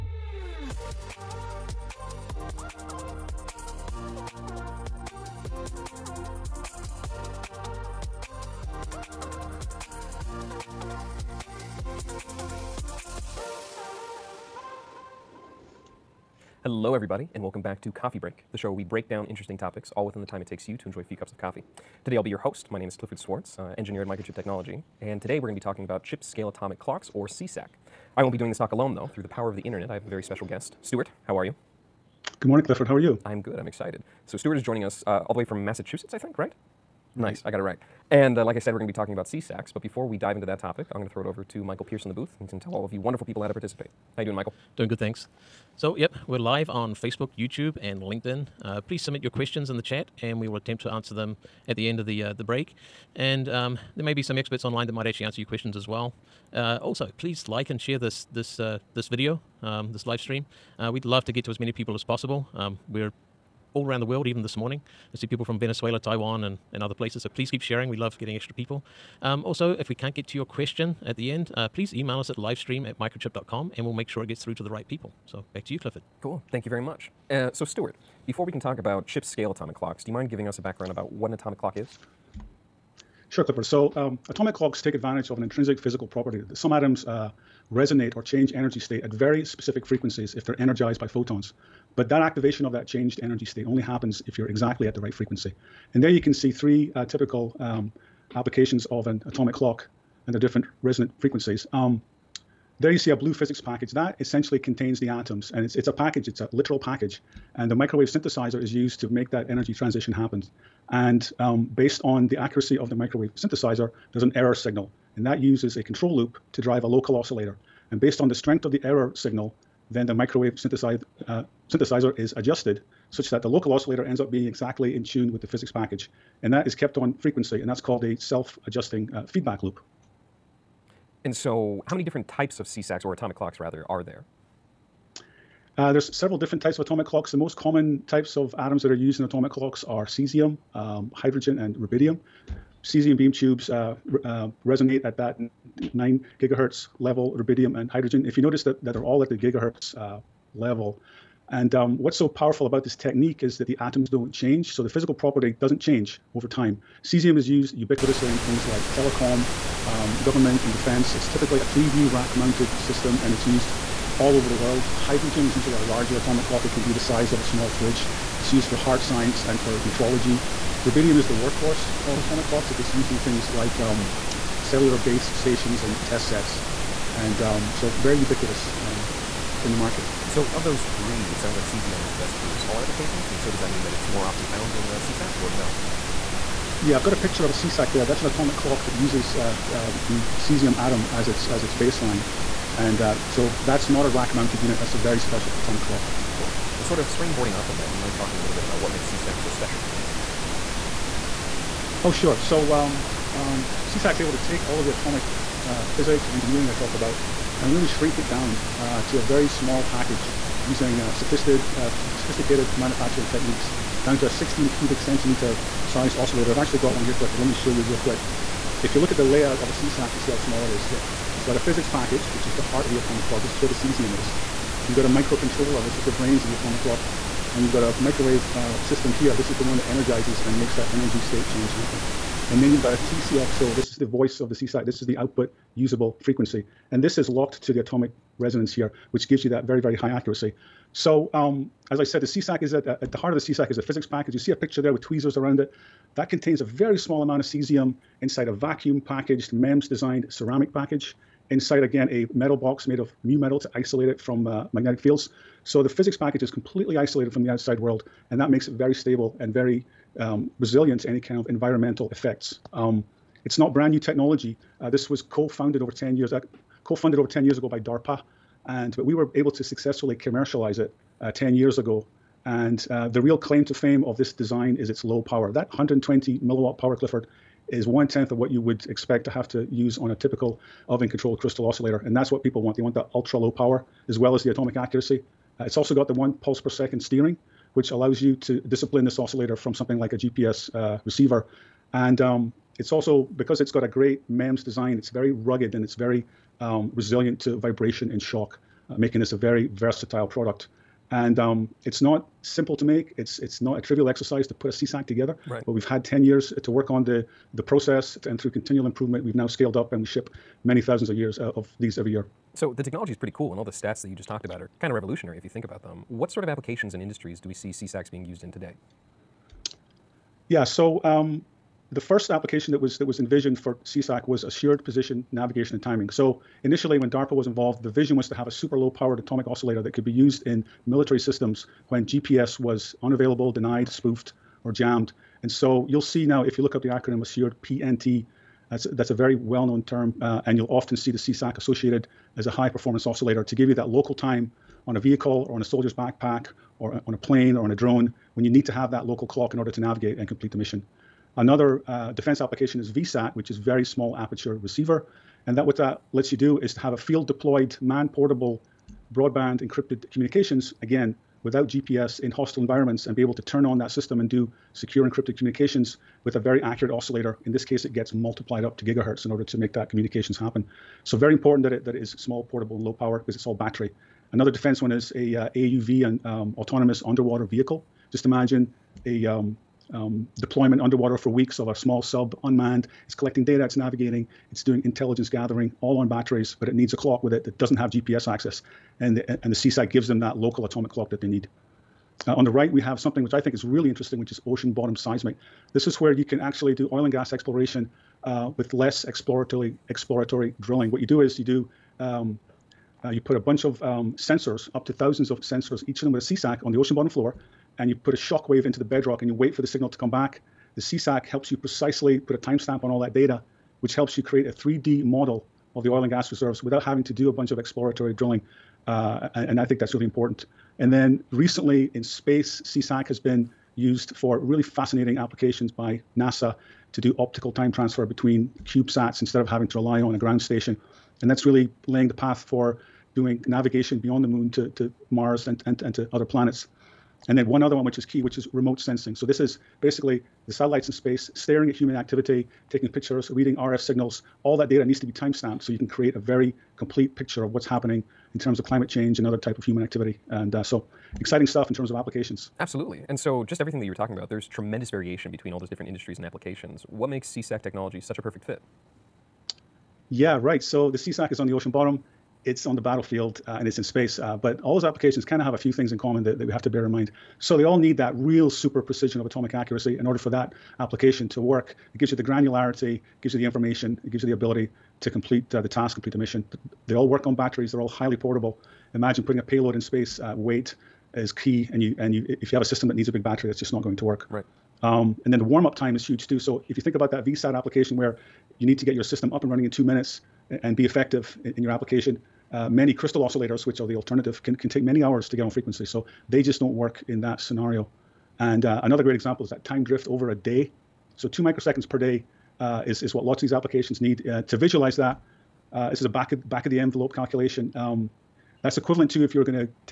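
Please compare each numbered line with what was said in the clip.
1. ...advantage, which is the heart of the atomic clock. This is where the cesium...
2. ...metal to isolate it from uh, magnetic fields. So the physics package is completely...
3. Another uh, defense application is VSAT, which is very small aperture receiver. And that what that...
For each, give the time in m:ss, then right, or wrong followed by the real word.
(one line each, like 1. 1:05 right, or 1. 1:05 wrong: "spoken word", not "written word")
1. 3:41 wrong: "package", not "advantage"
2. 4:13 right
3. 5:51 right.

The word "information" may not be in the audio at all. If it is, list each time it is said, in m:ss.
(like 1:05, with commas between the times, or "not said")
7:53.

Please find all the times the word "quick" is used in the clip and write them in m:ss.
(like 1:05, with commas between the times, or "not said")
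3:37.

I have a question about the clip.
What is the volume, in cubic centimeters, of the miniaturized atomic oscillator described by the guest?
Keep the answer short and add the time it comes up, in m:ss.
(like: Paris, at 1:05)
16, at 3:34.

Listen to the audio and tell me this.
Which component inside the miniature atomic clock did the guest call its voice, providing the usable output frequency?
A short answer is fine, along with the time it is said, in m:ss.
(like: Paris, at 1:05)
TCXO, at 3:52.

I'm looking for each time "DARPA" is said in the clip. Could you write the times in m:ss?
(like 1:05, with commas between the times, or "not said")
4:27, 5:27.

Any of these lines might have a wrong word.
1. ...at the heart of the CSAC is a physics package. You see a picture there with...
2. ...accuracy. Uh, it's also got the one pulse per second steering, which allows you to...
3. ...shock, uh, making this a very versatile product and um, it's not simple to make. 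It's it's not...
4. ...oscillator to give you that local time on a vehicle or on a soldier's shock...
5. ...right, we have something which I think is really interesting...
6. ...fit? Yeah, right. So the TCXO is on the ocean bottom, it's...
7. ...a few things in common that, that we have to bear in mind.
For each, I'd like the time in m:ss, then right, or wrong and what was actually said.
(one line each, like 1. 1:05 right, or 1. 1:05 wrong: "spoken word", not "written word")
1. 4:03 right
2. 4:44 right
3. 4:58 right
4. 5:43 wrong: "backpack", not "shock"
5. 6:32 right
6. 7:38 wrong: "CSAC", not "TCXO"
7. 7:45 right.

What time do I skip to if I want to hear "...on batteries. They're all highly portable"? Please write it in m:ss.
7:57.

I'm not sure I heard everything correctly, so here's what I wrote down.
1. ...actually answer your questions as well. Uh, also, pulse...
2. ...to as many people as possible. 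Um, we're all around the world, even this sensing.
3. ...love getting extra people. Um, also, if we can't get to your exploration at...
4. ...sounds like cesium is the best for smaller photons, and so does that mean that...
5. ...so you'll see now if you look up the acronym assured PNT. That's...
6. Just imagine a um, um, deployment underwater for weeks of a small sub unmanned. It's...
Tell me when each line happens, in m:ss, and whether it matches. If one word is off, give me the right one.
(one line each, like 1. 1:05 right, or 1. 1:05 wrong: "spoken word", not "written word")
1. 0:55 wrong: "please", not "pulse"
2. 1:01 wrong: "morning", not "sensing"
3. 1:07 wrong: "question", not "exploration"
4. 3:01 wrong: "applications", not "photons"
5. 5:35 right
6. 6:18 right.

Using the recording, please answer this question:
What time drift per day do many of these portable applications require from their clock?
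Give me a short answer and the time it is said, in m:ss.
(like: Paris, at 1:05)
2 microseconds, at 8:21.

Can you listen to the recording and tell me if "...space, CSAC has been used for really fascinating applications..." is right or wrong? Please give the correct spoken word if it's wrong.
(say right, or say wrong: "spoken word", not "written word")
right.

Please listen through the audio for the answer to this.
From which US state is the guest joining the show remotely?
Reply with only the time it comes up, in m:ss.
0:35.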